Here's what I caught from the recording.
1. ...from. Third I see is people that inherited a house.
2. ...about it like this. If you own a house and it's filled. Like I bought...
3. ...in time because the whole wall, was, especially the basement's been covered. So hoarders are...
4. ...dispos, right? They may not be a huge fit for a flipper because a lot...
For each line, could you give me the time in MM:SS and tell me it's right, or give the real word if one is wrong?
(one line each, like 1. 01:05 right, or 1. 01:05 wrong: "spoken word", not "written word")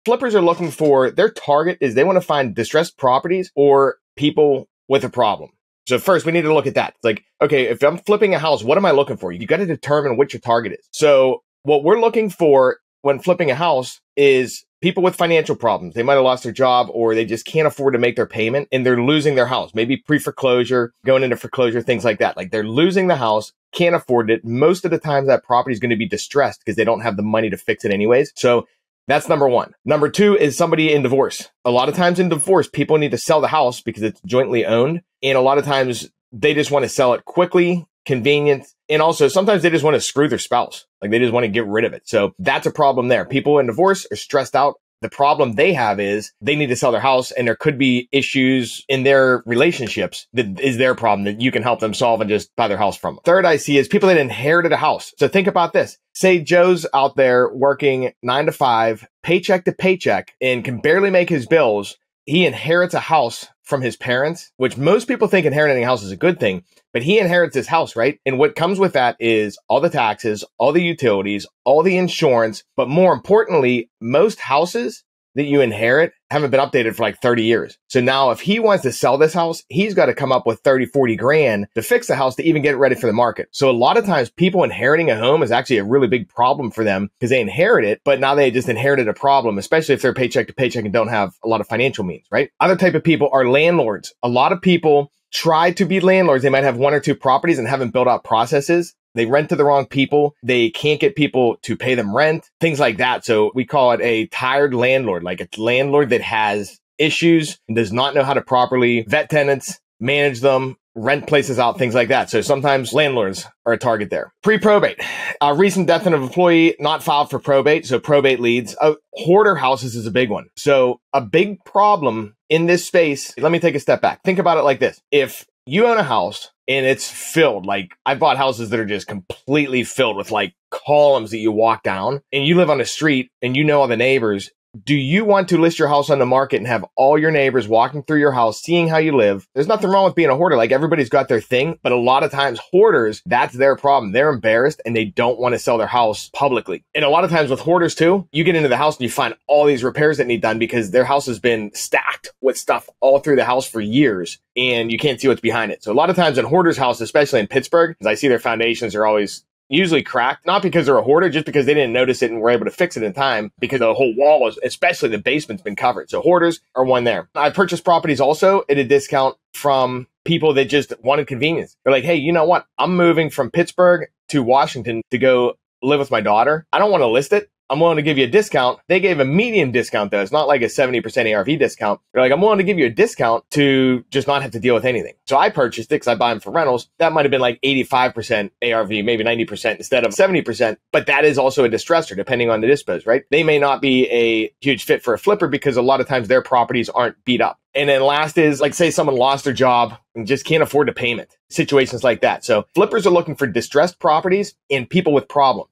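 1. 00:52 right
2. 02:04 right
3. 02:43 right
4. 03:12 right.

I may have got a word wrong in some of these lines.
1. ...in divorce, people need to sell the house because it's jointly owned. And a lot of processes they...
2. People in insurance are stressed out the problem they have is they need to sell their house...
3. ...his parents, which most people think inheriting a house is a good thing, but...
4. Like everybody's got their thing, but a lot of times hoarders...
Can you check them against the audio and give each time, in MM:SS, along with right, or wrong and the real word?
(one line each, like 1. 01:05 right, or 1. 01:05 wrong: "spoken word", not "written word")
1. 00:32 wrong: "times", not "processes"
2. 00:43 wrong: "divorce", not "insurance"
3. 01:03 right
4. 02:20 right.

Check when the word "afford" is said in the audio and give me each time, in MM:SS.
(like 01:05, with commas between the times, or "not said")
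00:17, 00:23, 03:20.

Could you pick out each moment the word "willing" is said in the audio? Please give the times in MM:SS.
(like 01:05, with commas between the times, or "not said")
02:57, 03:02.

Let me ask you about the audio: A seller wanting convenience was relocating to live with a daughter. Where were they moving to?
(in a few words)
Washington.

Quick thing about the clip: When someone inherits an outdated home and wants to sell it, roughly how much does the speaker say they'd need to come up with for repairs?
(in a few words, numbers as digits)
30 to 40 grand.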